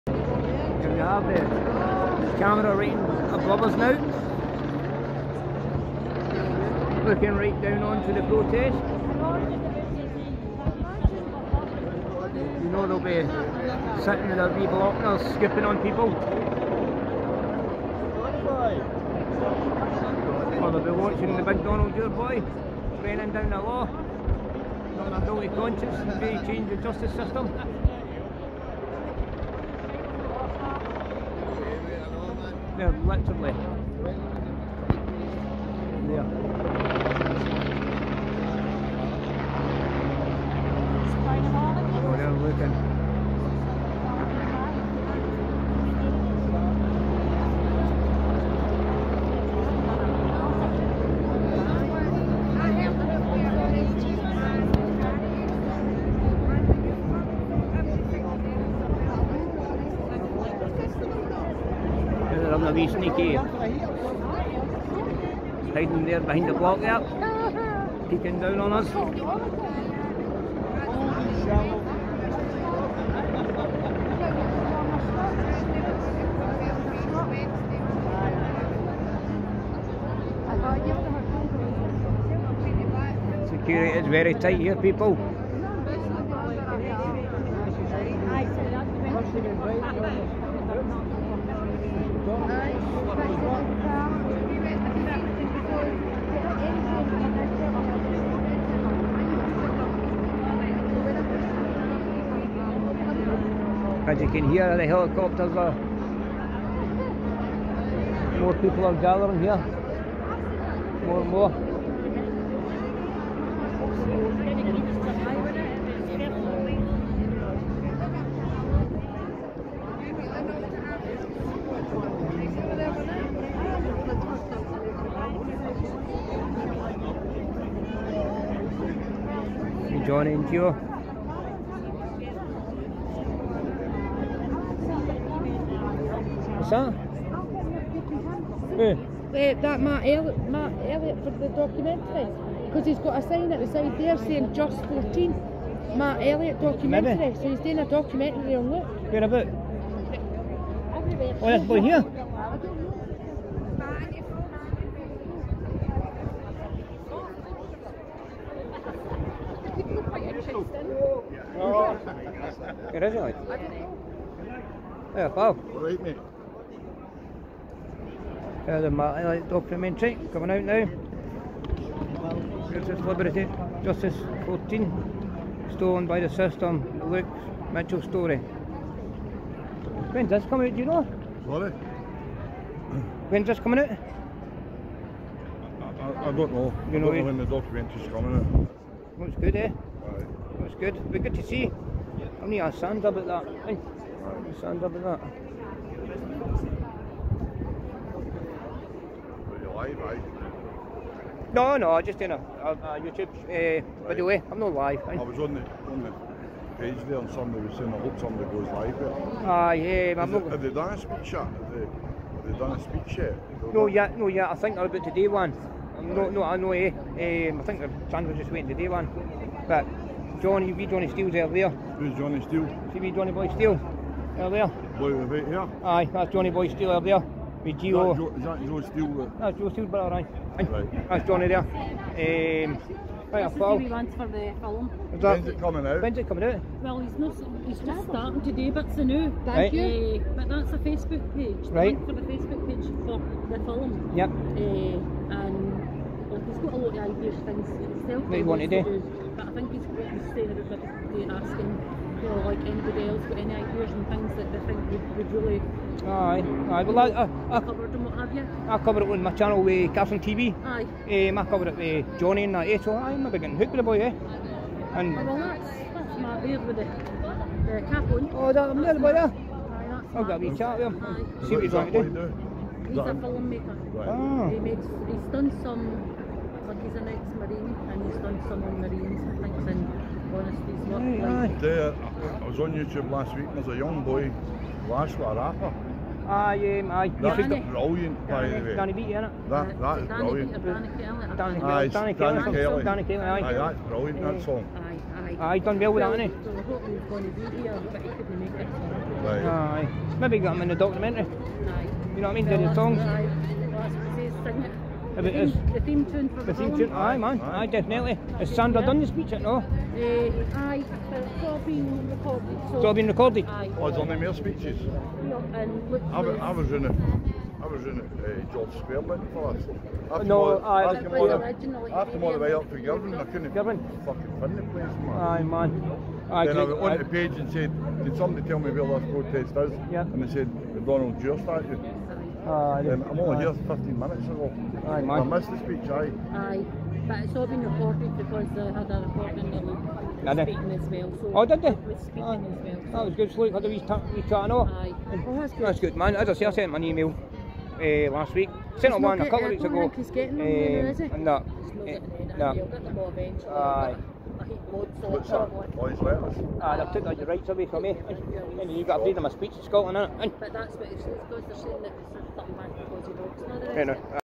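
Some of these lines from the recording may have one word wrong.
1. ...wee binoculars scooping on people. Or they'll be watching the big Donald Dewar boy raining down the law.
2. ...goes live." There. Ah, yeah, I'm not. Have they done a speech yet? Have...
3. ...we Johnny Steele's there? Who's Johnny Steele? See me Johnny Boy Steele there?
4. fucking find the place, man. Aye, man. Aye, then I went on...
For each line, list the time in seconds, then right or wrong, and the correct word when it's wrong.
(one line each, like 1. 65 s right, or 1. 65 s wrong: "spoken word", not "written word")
1. 14 s right
2. 208 s right
3. 220 s right
4. 324 s right.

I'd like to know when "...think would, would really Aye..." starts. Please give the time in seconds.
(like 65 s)
254 s.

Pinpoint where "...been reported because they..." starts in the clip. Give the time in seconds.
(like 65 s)
337 s.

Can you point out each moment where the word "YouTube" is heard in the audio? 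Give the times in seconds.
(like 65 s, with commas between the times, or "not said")
203 s, 282 s.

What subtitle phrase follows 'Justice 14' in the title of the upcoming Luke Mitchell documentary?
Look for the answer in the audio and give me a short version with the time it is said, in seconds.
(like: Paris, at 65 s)
stolen by the system, at 175 s.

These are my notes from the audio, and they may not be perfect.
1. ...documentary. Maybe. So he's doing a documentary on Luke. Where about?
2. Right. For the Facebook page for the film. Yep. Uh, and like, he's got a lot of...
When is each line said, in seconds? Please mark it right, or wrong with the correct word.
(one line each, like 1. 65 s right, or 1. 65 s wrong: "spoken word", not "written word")
1. 146 s right
2. 241 s right.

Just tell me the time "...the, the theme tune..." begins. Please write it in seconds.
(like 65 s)
306 s.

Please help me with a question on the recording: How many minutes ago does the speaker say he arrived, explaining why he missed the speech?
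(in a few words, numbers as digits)
15.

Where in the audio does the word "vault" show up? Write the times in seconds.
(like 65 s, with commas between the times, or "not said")
not said.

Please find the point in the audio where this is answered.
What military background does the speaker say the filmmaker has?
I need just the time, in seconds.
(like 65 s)
277 s.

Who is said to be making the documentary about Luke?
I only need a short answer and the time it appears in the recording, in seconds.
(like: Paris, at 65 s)
Matt Elliott, at 140 s.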